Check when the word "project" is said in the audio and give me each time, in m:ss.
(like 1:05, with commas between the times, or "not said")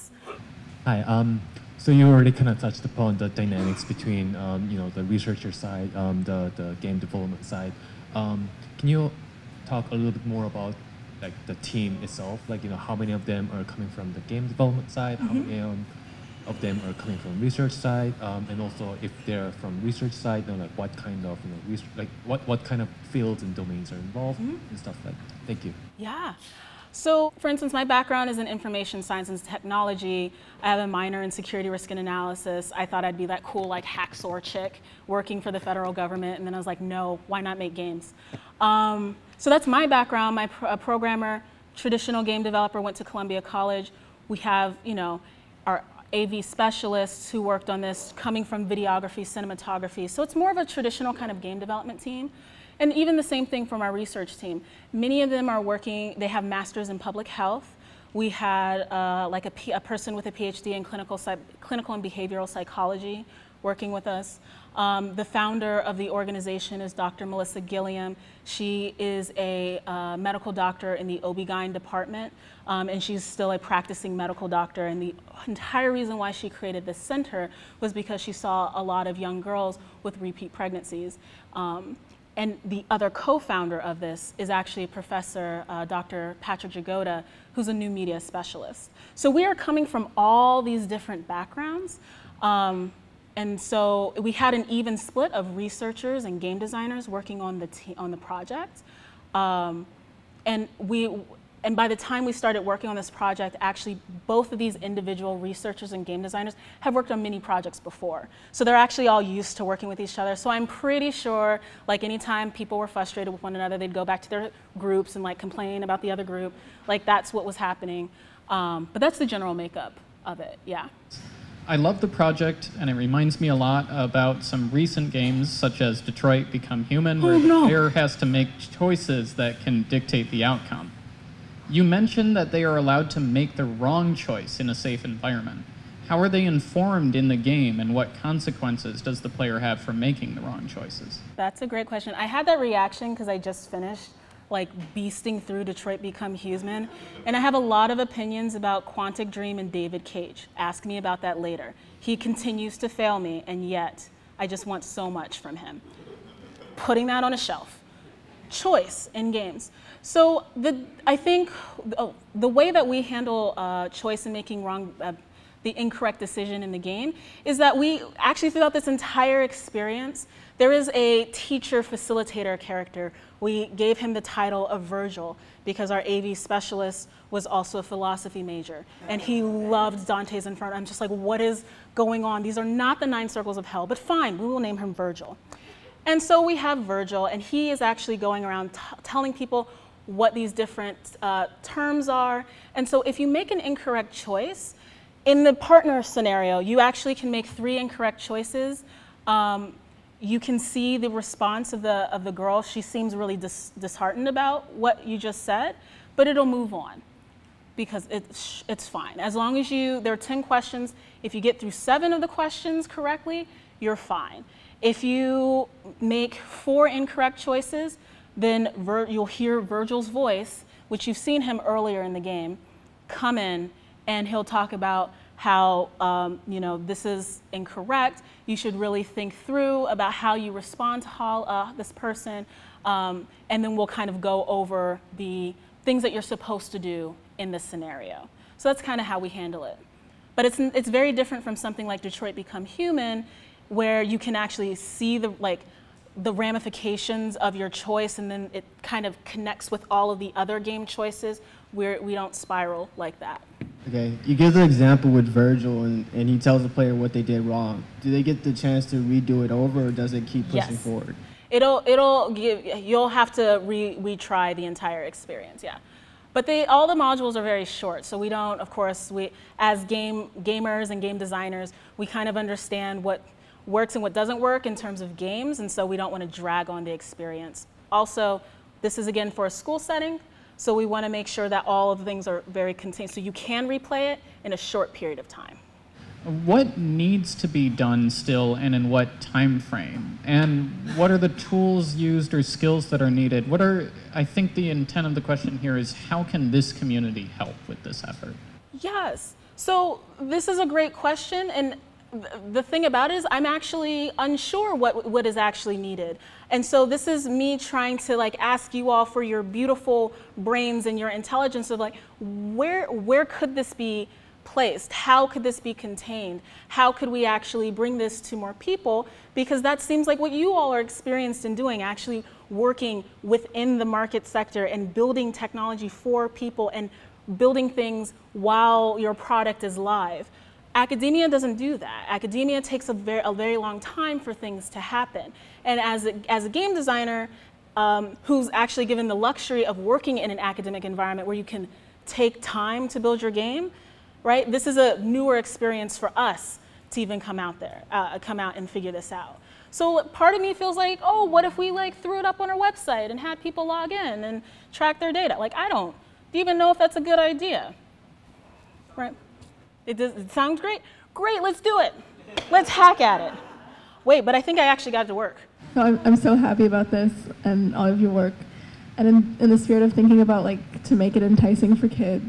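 1:38, 1:43, 1:47, 2:02.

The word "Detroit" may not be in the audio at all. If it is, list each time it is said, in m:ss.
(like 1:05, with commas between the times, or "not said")
2:06, 2:25, 4:02.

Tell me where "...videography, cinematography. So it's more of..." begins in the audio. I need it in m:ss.
0:48.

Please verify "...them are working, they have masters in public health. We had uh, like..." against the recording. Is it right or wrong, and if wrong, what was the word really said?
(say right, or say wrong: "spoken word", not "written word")
right.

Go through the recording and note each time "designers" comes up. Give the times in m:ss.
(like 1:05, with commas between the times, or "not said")
1:36, 1:46, 4:31, 5:36.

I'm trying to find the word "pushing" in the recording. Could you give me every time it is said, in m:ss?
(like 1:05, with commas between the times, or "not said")
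4:20.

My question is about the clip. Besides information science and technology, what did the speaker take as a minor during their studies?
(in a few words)
Security risk and analysis.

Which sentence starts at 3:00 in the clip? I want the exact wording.
I'm just like, what is going on?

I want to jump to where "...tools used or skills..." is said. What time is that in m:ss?
4:51.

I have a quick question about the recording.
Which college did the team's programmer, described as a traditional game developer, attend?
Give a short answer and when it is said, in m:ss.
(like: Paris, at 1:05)
Columbia College, at 0:43.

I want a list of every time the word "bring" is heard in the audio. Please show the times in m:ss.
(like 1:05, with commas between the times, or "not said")
5:17.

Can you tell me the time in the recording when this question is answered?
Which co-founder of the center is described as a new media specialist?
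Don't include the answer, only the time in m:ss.
1:26.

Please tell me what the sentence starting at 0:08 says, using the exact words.
Um, can you talk a little bit more about like the team itself?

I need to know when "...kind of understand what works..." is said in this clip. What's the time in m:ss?
4:32.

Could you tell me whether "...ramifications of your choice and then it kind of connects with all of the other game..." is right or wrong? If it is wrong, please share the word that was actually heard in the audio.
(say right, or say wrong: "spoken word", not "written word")
right.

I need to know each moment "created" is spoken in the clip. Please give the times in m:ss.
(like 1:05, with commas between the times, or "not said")
1:16.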